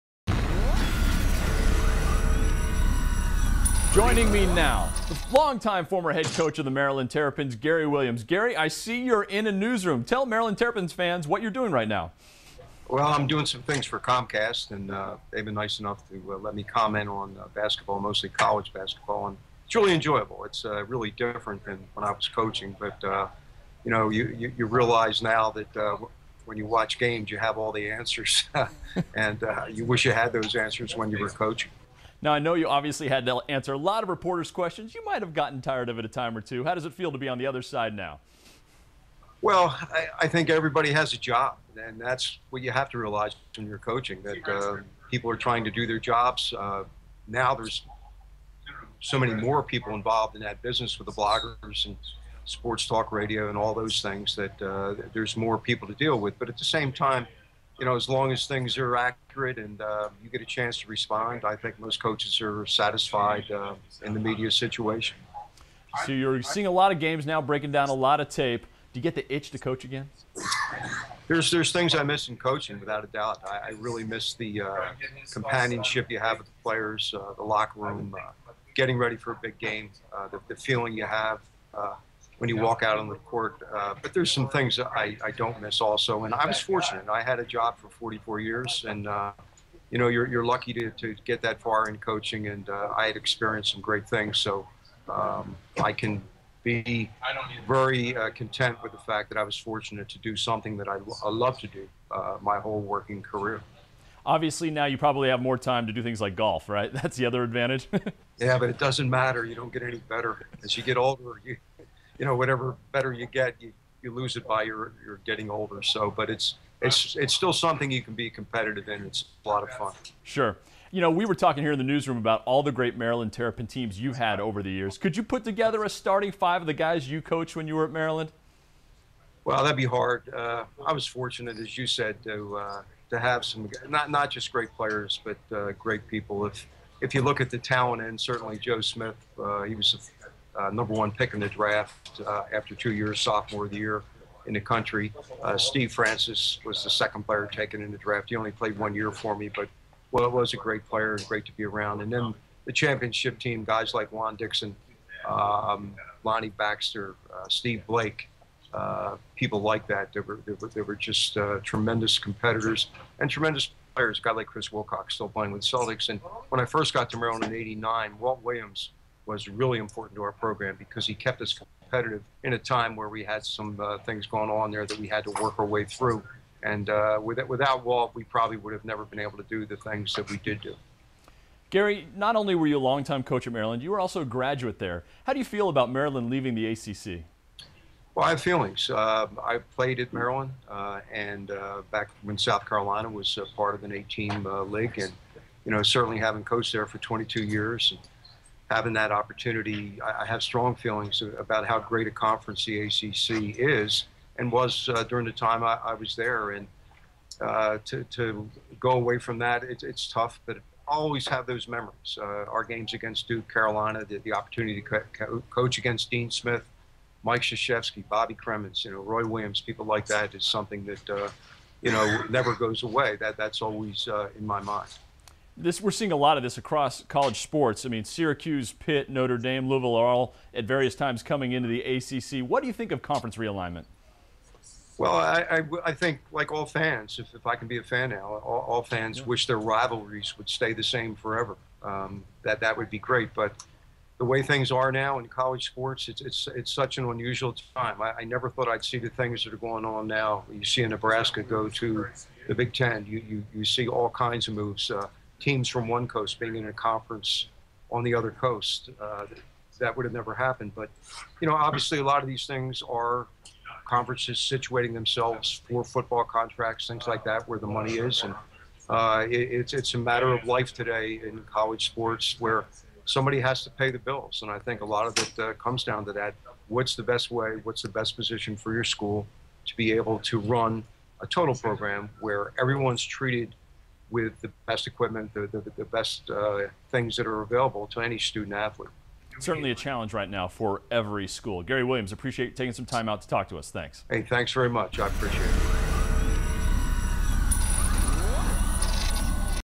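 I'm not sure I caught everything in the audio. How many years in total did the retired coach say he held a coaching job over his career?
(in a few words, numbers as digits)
44.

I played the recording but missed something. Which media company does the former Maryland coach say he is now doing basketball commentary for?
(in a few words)
Comcast.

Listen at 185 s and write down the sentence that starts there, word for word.
How do you feel about Maryland leaving the ACC?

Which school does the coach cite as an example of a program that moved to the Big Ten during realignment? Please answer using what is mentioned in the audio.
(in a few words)
Nebraska.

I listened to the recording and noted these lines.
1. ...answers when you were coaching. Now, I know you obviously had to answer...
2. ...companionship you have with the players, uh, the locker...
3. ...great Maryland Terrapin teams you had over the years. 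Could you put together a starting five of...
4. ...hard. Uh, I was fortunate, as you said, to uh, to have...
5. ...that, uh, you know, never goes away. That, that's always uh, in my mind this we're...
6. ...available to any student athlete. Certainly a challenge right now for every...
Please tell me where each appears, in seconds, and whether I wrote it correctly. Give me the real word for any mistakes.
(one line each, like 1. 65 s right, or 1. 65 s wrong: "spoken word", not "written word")
1. 30 s right
2. 75 s right
3. 122 s right
4. 129 s right
5. 220 s right
6. 287 s right.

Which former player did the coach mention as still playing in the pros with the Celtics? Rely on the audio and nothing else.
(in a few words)
Chris Wilcox.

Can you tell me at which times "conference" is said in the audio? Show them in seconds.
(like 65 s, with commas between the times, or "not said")
202 s, 233 s, 256 s, 263 s.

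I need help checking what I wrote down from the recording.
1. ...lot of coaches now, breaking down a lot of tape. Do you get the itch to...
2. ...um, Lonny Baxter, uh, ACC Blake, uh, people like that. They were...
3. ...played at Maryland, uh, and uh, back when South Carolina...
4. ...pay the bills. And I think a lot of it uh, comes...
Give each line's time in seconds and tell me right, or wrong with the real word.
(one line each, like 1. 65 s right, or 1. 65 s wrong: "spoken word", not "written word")
1. 66 s wrong: "games", not "coaches"
2. 155 s wrong: "Steve", not "ACC"
3. 189 s right
4. 273 s right.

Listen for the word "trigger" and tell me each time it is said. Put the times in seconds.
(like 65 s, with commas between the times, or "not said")
not said.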